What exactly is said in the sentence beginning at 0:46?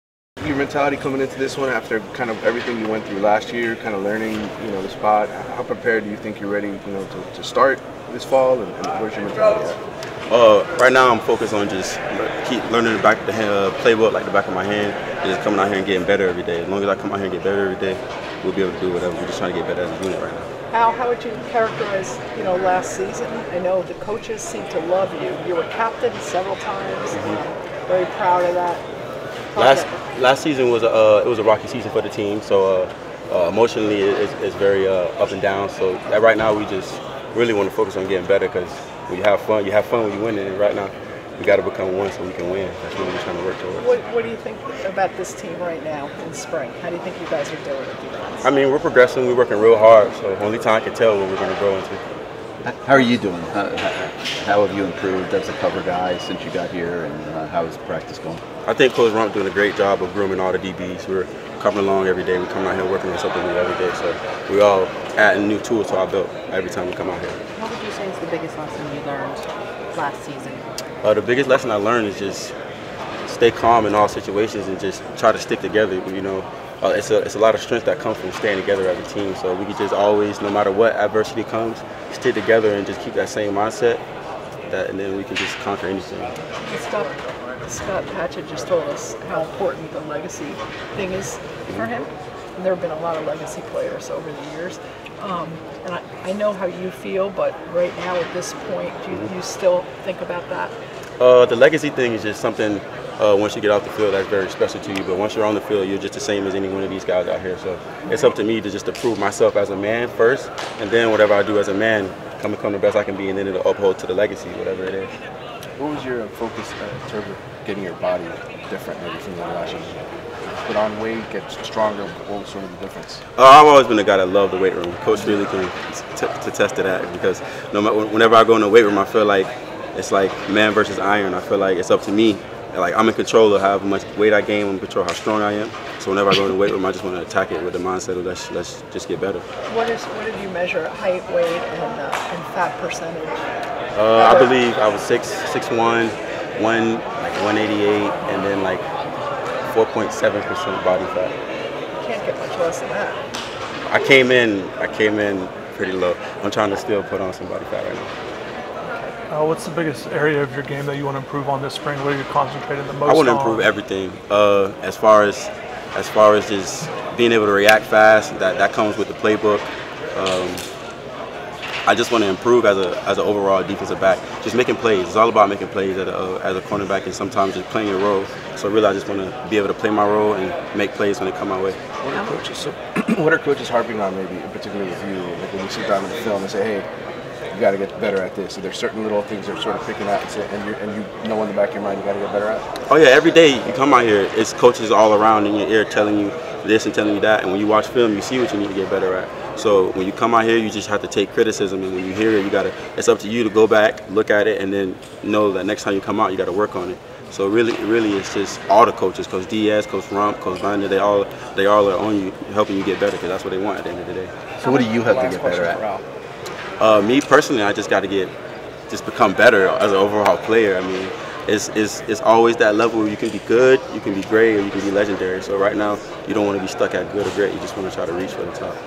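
How do you think you guys are doing?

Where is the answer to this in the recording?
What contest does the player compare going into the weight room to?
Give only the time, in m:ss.
2:10.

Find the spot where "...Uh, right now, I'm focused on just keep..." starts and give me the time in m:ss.
0:10.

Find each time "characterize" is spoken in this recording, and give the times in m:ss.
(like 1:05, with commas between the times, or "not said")
0:21.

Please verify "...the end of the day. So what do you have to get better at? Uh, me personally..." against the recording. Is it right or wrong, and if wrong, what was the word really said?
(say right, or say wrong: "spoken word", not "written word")
right.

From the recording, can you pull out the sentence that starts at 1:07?
What would you say is the biggest lesson you learned last season?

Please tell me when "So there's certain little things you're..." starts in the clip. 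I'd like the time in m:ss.
3:08.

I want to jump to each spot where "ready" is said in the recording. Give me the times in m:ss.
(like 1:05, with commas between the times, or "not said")
0:06.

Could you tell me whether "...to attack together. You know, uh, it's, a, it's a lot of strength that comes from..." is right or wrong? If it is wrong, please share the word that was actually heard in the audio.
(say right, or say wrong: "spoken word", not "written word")
wrong: "stick", not "attack".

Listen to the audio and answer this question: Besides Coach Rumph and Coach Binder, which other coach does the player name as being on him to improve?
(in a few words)
Coach Diaz.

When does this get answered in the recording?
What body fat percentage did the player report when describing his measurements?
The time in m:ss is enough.
2:29.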